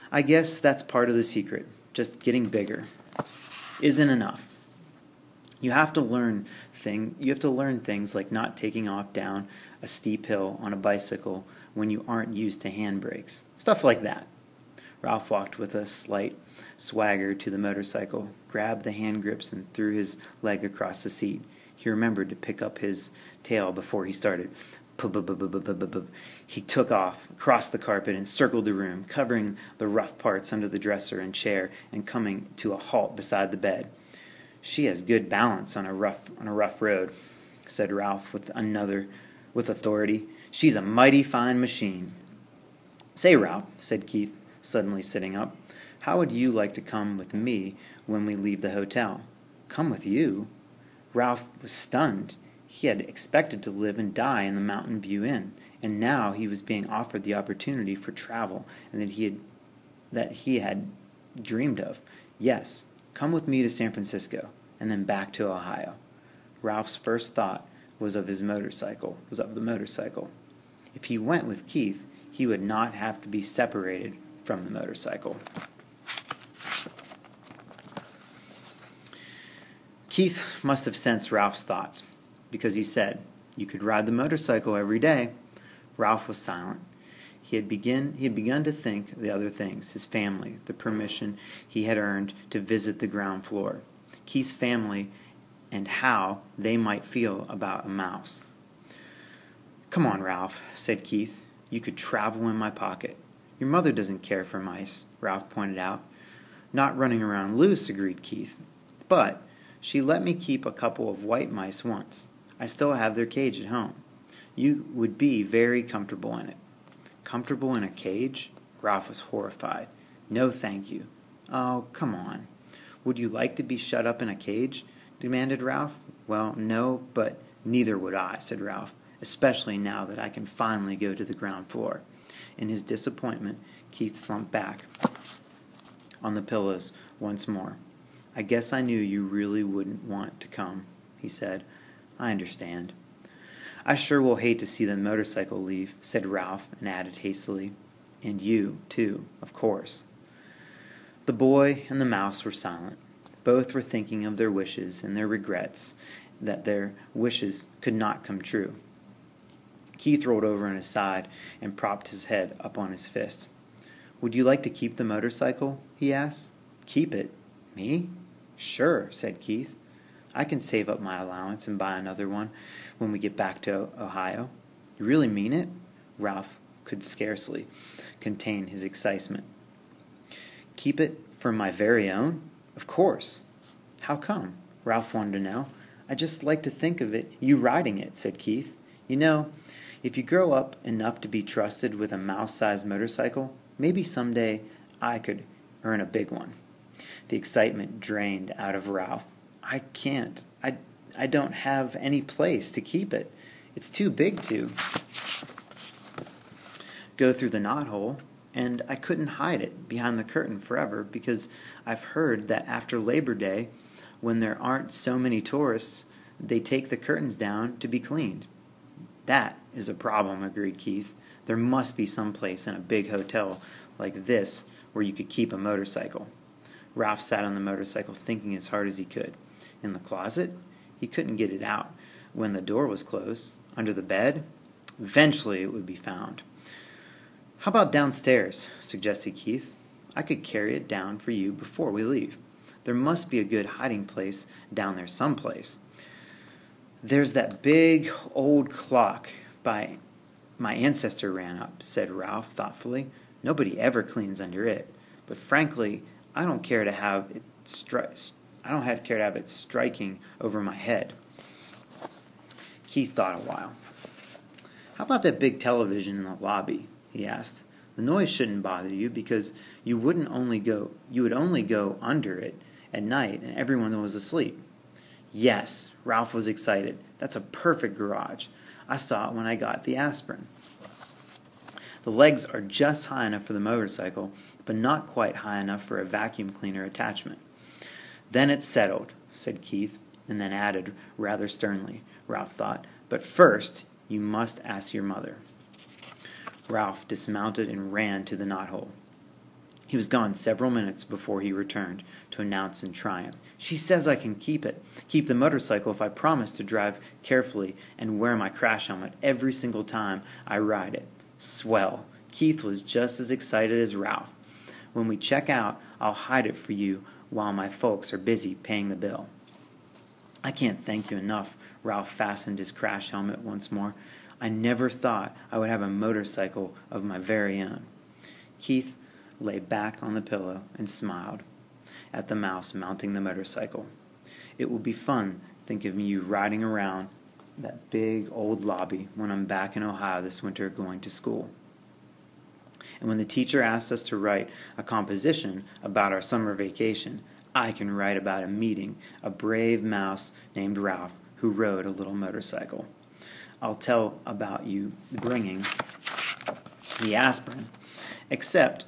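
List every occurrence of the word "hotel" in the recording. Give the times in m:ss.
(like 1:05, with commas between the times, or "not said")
0:48, 3:43.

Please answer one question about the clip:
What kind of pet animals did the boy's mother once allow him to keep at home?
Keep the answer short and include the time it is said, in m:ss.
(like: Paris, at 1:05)
white mice, at 1:51.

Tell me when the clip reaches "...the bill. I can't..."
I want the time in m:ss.
5:18.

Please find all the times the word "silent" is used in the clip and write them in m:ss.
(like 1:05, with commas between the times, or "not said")
1:26, 2:32.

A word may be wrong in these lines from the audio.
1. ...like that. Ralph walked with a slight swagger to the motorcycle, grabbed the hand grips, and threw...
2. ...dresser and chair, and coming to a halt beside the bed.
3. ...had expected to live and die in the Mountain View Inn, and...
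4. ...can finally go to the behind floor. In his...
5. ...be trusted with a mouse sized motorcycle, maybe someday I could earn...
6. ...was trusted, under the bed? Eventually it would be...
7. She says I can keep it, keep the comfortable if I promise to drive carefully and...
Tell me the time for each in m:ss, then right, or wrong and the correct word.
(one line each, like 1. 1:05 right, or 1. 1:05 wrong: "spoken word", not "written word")
1. 0:13 right
2. 0:30 right
3. 0:52 right
4. 2:10 wrong: "ground", not "behind"
5. 3:11 right
6. 3:52 wrong: "closed", not "trusted"
7. 5:03 wrong: "motorcycle", not "comfortable".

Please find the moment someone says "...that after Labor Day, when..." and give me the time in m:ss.
3:32.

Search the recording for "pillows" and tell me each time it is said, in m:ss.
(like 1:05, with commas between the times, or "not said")
2:16, 5:30.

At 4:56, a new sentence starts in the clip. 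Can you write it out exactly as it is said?
Ralph dismounted and ran to the knothole.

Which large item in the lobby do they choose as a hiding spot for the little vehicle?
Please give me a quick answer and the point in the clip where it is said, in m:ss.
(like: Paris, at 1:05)
television, at 4:25.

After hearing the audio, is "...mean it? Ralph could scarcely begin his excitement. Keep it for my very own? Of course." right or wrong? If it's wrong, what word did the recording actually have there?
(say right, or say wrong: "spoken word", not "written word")
wrong: "contain", not "begin".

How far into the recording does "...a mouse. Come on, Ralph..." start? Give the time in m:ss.
1:37.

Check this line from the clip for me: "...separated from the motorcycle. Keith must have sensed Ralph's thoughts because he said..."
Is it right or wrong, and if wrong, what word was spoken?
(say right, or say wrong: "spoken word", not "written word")
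right.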